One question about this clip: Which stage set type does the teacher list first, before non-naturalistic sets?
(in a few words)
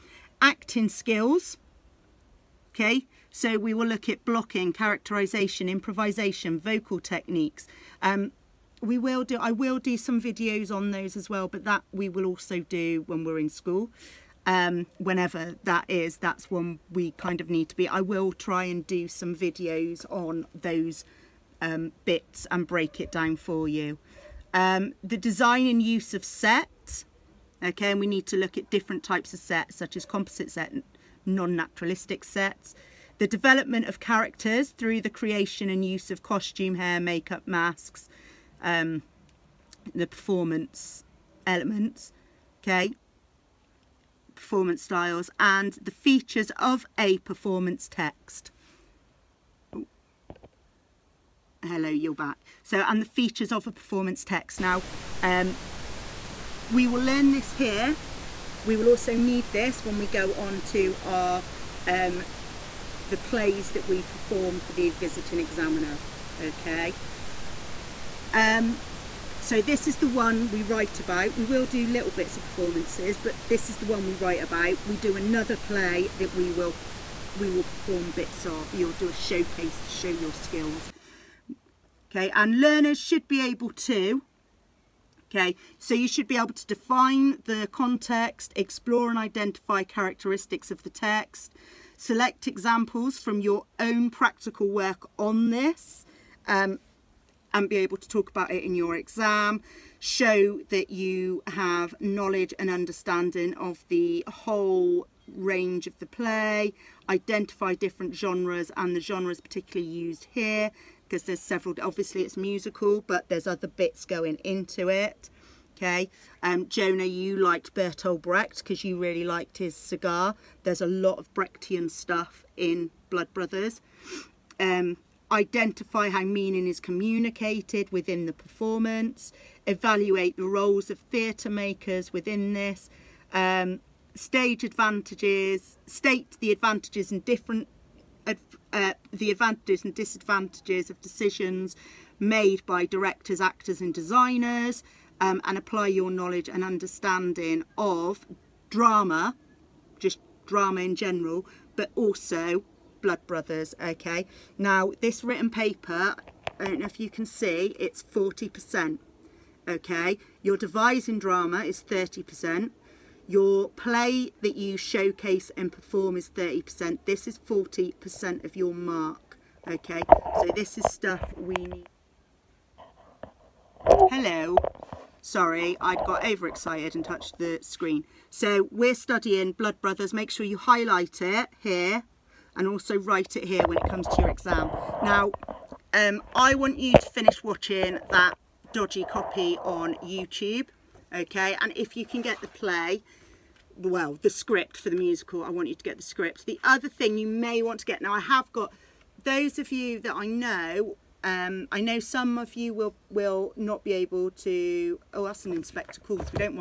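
Composite set.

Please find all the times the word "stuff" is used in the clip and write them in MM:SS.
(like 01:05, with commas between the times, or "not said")
02:01, 02:50.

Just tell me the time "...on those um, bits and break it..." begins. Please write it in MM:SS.
00:20.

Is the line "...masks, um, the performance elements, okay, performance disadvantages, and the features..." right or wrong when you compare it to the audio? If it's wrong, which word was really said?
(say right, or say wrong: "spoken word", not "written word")
wrong: "styles", not "disadvantages".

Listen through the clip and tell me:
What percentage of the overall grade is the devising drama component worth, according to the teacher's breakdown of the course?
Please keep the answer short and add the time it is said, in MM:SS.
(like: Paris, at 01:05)
30%, at 02:40.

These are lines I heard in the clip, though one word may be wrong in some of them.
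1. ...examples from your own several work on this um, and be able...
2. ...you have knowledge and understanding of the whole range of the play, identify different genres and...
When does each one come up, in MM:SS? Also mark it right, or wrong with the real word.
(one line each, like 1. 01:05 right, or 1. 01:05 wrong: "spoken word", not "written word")
1. 01:32 wrong: "practical", not "several"
2. 01:40 right.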